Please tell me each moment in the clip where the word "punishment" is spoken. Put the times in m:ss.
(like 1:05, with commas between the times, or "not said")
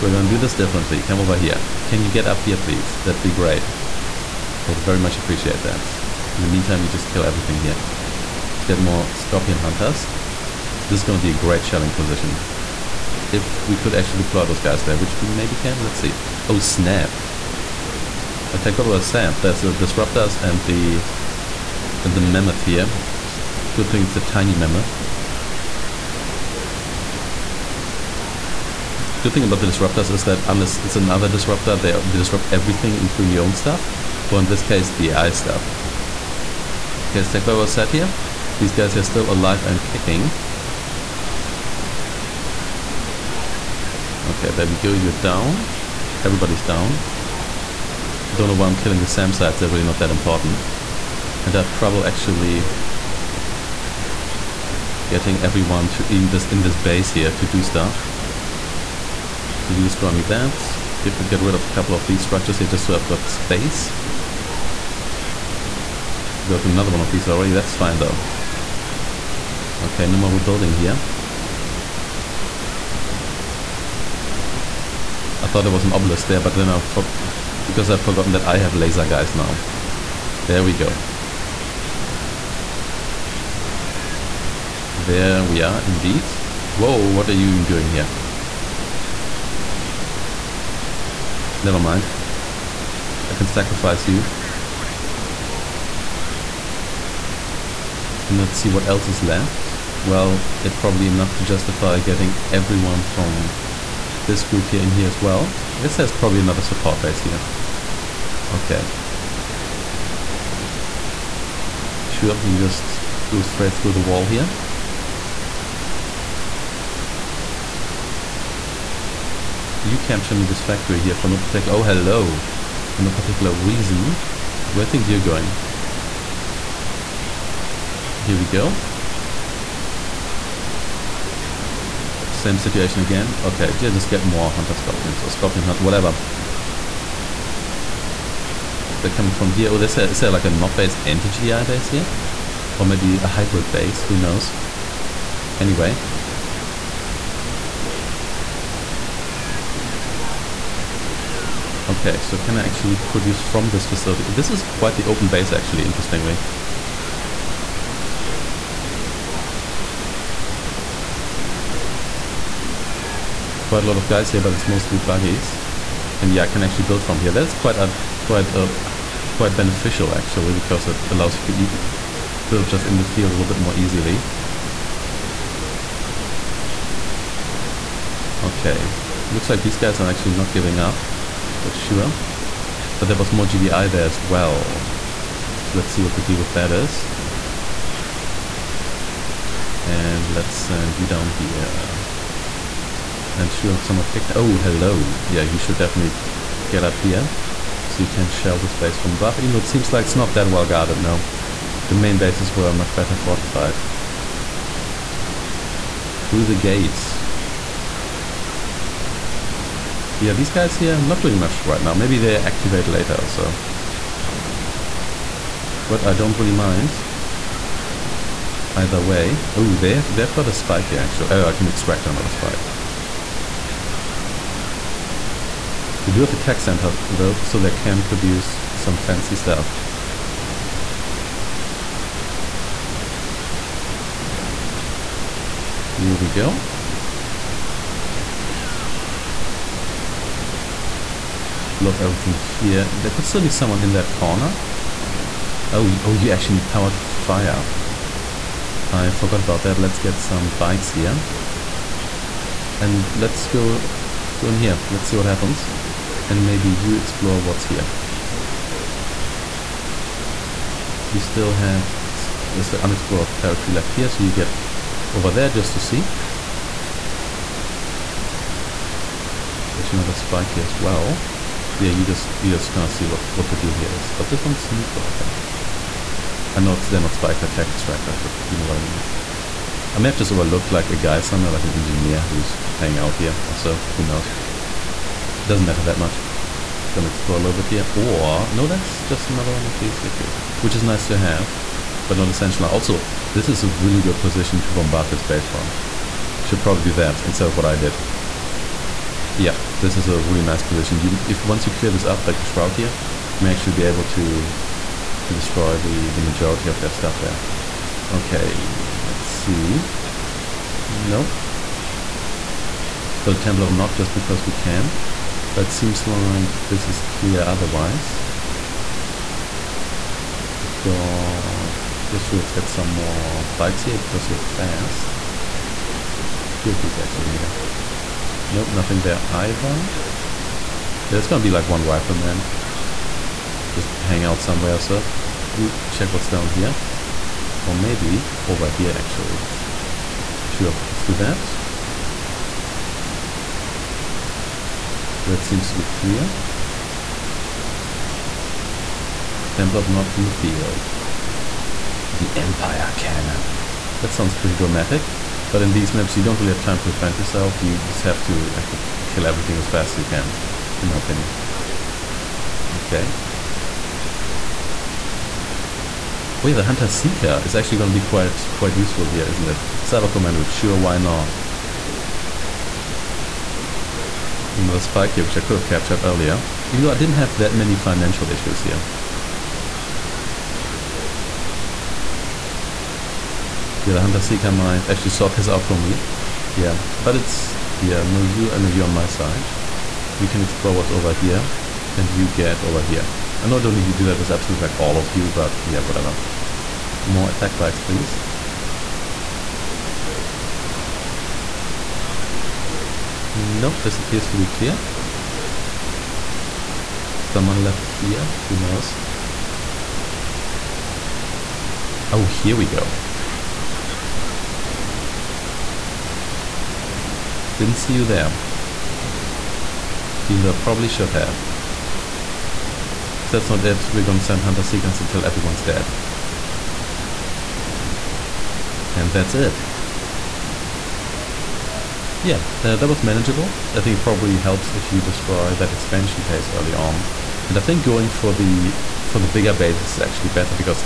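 not said.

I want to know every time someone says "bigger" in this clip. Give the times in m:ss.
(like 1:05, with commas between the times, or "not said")
7:19.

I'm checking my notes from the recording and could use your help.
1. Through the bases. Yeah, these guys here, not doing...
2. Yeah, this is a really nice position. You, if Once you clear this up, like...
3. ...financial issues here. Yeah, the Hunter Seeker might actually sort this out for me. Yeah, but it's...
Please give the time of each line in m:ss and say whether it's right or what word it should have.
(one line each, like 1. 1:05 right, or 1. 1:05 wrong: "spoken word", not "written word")
1. 3:26 wrong: "gates", not "bases"
2. 4:59 right
3. 6:17 right.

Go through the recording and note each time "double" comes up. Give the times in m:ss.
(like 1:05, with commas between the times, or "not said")
0:18, 0:37.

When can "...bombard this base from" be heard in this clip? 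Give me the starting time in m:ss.
4:54.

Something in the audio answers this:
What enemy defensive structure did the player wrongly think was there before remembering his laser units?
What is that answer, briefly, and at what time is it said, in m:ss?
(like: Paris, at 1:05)
Obelisk, at 1:15.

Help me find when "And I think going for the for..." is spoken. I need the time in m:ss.
7:17.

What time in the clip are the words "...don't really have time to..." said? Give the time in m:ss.
5:56.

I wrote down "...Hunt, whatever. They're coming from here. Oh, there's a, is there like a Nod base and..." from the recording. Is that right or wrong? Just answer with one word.
right.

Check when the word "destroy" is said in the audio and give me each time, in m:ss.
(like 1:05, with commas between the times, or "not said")
0:59, 5:05, 7:15.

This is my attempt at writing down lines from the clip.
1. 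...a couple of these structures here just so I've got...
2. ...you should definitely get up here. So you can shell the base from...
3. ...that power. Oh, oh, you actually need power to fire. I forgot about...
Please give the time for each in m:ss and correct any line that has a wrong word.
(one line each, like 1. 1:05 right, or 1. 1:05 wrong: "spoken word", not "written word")
1. 1:01 right
2. 3:15 right
3. 4:03 wrong: "corner", not "power".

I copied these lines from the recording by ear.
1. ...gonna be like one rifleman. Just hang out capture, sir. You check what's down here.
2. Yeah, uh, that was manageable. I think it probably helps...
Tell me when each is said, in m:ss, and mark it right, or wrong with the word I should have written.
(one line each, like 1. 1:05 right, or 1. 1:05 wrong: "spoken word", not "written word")
1. 5:31 wrong: "somewhere", not "capture"
2. 7:12 right.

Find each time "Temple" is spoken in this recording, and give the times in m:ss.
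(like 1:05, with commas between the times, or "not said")
5:13, 5:49.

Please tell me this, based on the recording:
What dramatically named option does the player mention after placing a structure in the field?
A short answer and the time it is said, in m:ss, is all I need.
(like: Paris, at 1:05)
Empire Cannon, at 5:52.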